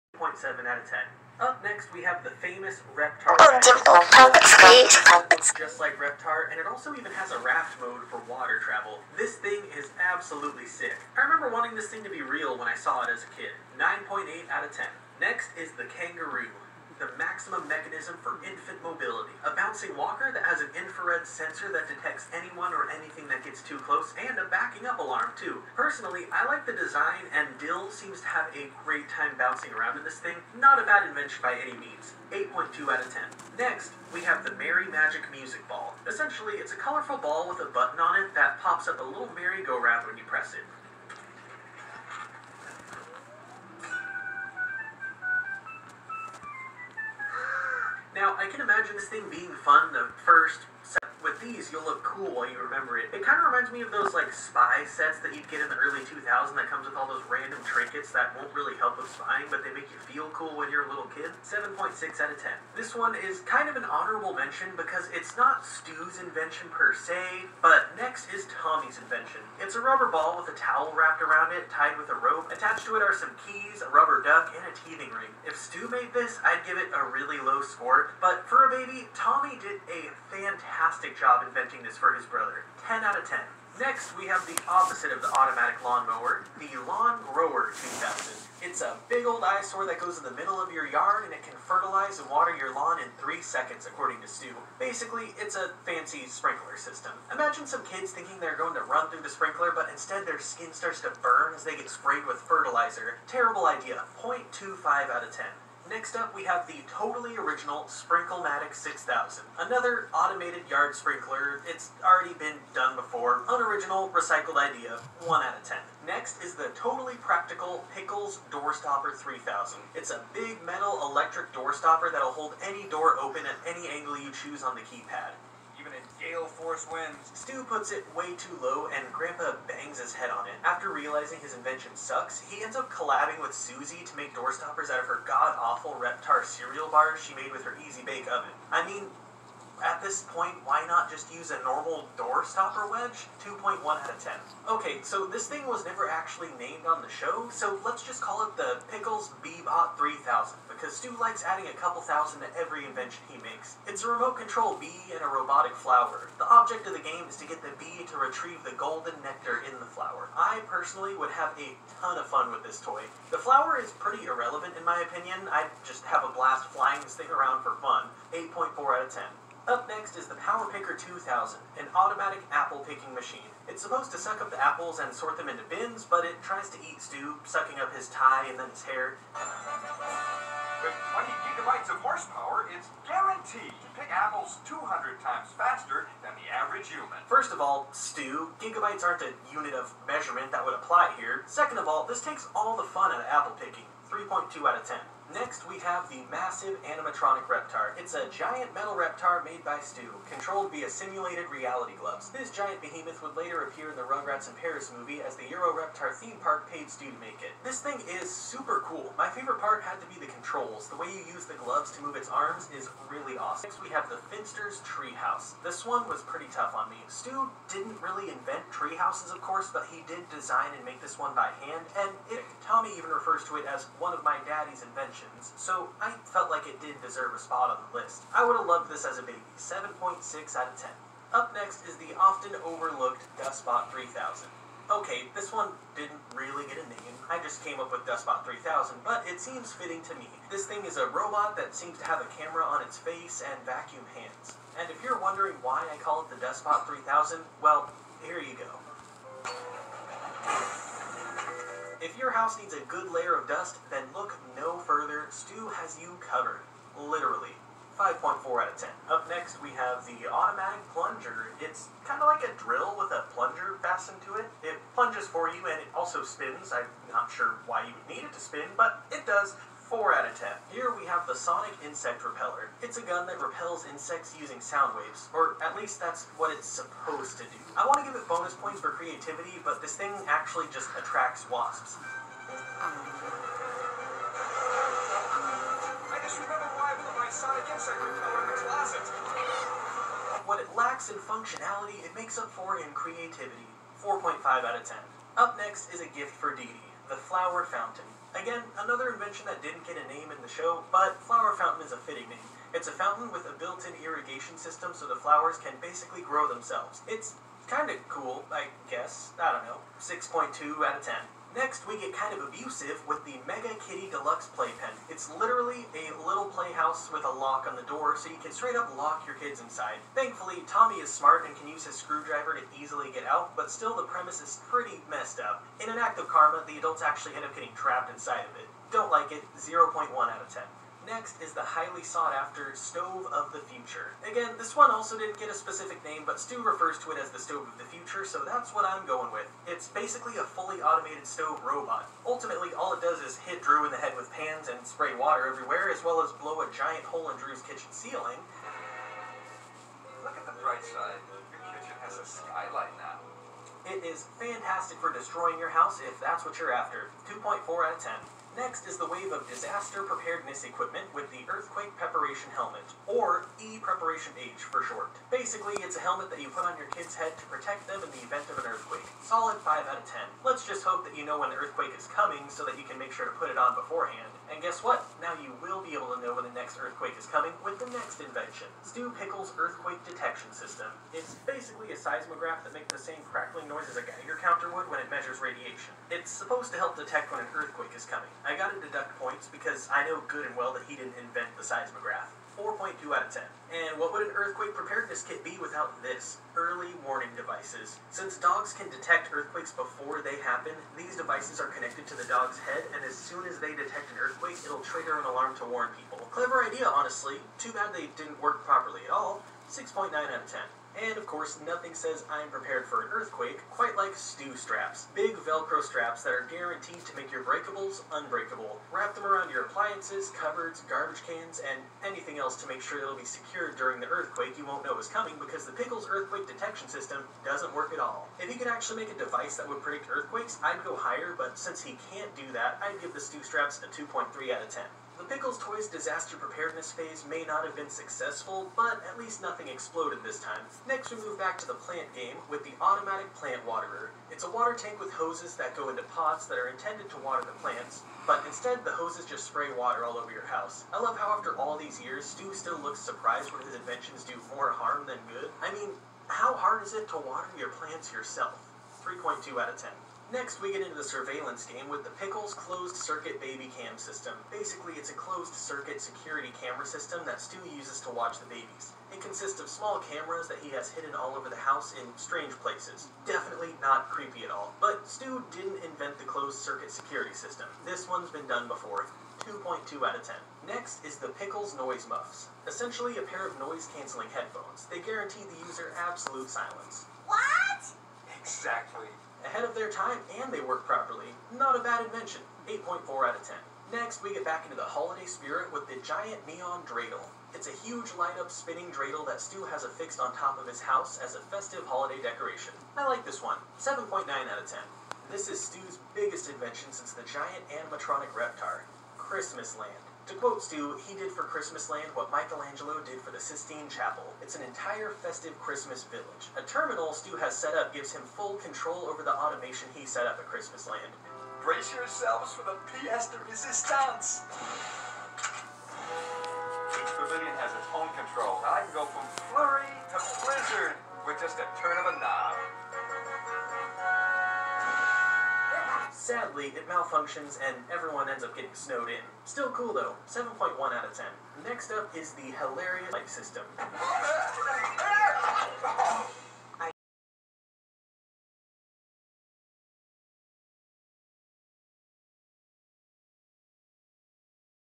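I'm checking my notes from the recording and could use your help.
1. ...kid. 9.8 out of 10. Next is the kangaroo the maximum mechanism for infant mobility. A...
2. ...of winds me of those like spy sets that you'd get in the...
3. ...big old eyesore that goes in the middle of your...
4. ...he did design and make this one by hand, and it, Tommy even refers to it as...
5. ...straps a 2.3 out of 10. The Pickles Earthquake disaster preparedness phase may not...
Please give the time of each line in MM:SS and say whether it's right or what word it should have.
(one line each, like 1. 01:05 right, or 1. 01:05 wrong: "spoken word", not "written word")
1. 00:13 right
2. 00:53 wrong: "reminds", not "winds"
3. 01:29 right
4. 03:39 right
5. 07:13 wrong: "Toys", not "Earthquake".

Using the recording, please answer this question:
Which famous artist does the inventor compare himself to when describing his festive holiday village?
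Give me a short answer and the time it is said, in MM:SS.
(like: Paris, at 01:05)
Michelangelo, at 08:32.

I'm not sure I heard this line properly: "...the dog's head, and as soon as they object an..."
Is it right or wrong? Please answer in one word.
wrong.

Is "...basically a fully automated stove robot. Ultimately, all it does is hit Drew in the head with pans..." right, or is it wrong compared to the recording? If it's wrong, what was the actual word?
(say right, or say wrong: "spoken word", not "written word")
right.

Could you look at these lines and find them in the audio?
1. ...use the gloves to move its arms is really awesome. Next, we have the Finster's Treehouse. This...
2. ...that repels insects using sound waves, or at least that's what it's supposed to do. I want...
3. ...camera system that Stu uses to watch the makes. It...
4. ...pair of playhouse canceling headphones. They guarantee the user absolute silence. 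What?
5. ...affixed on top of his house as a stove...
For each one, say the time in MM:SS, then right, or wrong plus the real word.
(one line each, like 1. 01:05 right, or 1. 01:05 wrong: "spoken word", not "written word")
1. 03:31 right
2. 04:33 right
3. 07:46 wrong: "babies", not "makes"
4. 08:03 wrong: "noise", not "playhouse"
5. 08:19 wrong: "festive", not "stove".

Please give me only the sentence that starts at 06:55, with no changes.
Big Velcro straps that are guaranteed to make your breakables unbreakable.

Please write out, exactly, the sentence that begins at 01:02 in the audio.
This one is kind of an honorable mention because it's not Stu's invention per se, but next is Tommy's invention.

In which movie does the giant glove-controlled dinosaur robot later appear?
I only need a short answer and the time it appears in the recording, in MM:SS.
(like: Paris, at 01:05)
Rugrats in Paris, at 03:24.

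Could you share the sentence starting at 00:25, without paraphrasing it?
Personally, I like the design, and Dill seems to have a great time bouncing around in this thing.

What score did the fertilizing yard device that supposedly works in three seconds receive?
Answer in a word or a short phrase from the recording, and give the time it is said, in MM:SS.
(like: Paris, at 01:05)
0.25, at 01:44.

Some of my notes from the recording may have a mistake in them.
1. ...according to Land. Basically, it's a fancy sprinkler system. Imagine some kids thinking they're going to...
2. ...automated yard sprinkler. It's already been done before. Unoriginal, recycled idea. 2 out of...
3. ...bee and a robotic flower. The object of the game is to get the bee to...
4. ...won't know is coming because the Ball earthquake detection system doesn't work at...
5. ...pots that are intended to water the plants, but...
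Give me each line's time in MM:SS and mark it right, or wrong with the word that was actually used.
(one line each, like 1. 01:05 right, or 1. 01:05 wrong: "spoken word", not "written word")
1. 01:33 wrong: "Stu", not "Land"
2. 01:50 wrong: "1", not "2"
3. 02:34 right
4. 07:04 wrong: "Pickles", not "Ball"
5. 07:26 right.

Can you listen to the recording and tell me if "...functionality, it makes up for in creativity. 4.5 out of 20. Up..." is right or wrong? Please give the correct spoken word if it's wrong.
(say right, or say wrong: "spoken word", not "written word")
wrong: "10", not "20".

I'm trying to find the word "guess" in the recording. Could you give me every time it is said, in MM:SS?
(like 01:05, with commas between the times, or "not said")
05:08, 06:14.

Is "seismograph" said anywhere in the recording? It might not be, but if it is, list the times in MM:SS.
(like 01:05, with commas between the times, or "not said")
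06:21, 06:31.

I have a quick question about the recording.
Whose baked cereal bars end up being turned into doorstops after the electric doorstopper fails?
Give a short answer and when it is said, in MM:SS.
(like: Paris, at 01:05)
Susie, at 02:13.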